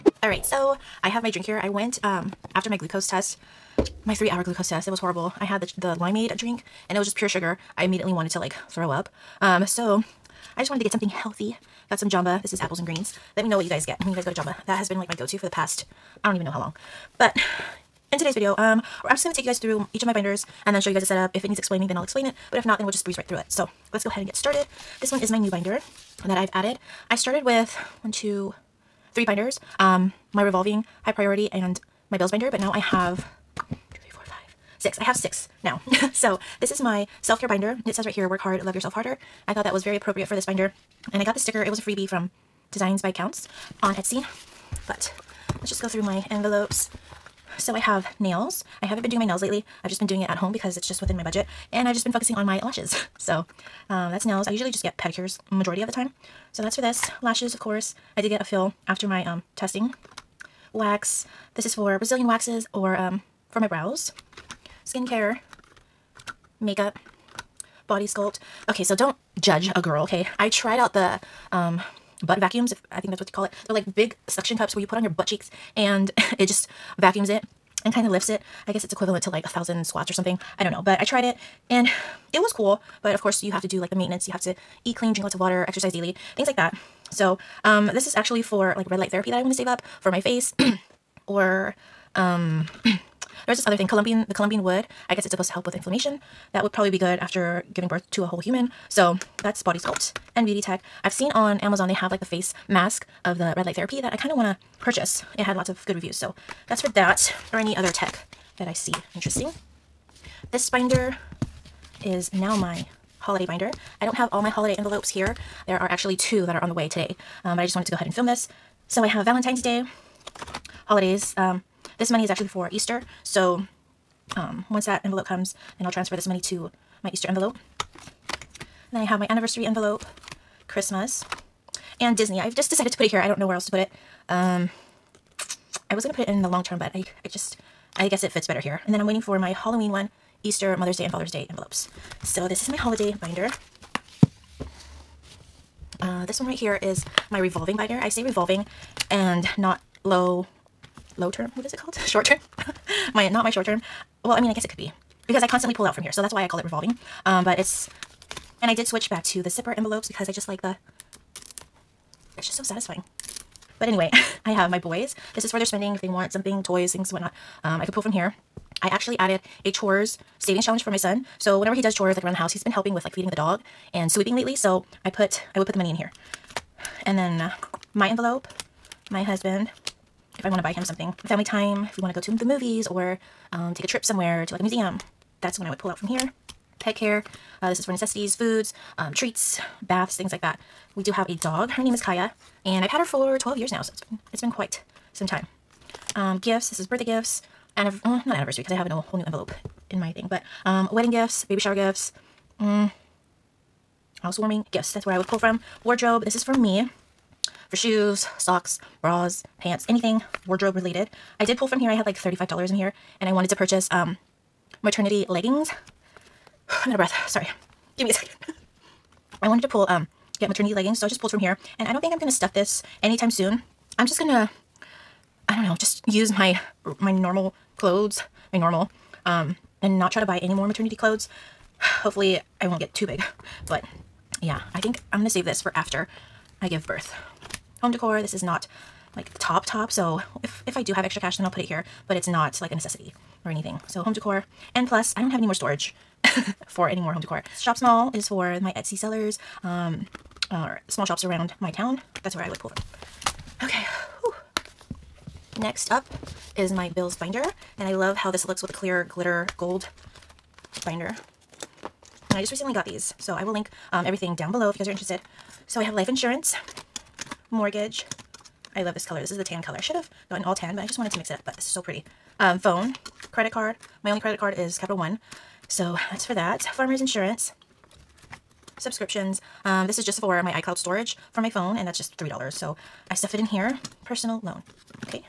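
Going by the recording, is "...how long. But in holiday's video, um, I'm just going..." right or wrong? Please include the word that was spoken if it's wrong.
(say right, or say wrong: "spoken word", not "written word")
wrong: "today", not "holiday".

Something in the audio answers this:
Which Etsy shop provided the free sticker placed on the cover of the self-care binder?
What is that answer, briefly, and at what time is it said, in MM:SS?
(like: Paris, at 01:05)
Designs by Kountz, at 00:42.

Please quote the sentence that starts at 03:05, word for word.
That's when I would pull out from here.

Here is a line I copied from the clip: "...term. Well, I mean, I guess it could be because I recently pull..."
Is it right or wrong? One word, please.
wrong.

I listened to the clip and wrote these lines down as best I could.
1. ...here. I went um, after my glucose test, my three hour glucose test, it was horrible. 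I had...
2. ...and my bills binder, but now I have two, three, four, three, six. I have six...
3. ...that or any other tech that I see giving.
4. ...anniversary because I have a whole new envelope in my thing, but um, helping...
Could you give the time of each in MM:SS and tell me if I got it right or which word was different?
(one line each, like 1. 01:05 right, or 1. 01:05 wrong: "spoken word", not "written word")
1. 00:01 right
2. 00:31 wrong: "five", not "three"
3. 01:46 wrong: "interesting", not "giving"
4. 03:18 wrong: "wedding", not "helping".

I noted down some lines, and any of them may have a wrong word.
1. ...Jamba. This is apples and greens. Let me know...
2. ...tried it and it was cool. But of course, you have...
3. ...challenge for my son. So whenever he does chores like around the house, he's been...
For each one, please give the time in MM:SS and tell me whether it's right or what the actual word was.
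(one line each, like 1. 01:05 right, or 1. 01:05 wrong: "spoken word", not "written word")
1. 00:12 right
2. 01:21 right
3. 02:50 right.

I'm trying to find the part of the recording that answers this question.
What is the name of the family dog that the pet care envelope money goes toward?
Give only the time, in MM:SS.
03:12.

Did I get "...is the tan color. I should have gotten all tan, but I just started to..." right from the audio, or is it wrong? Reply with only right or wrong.
wrong.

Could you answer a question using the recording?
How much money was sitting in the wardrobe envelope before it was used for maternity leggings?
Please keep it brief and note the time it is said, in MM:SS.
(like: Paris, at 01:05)
$35, at 03:32.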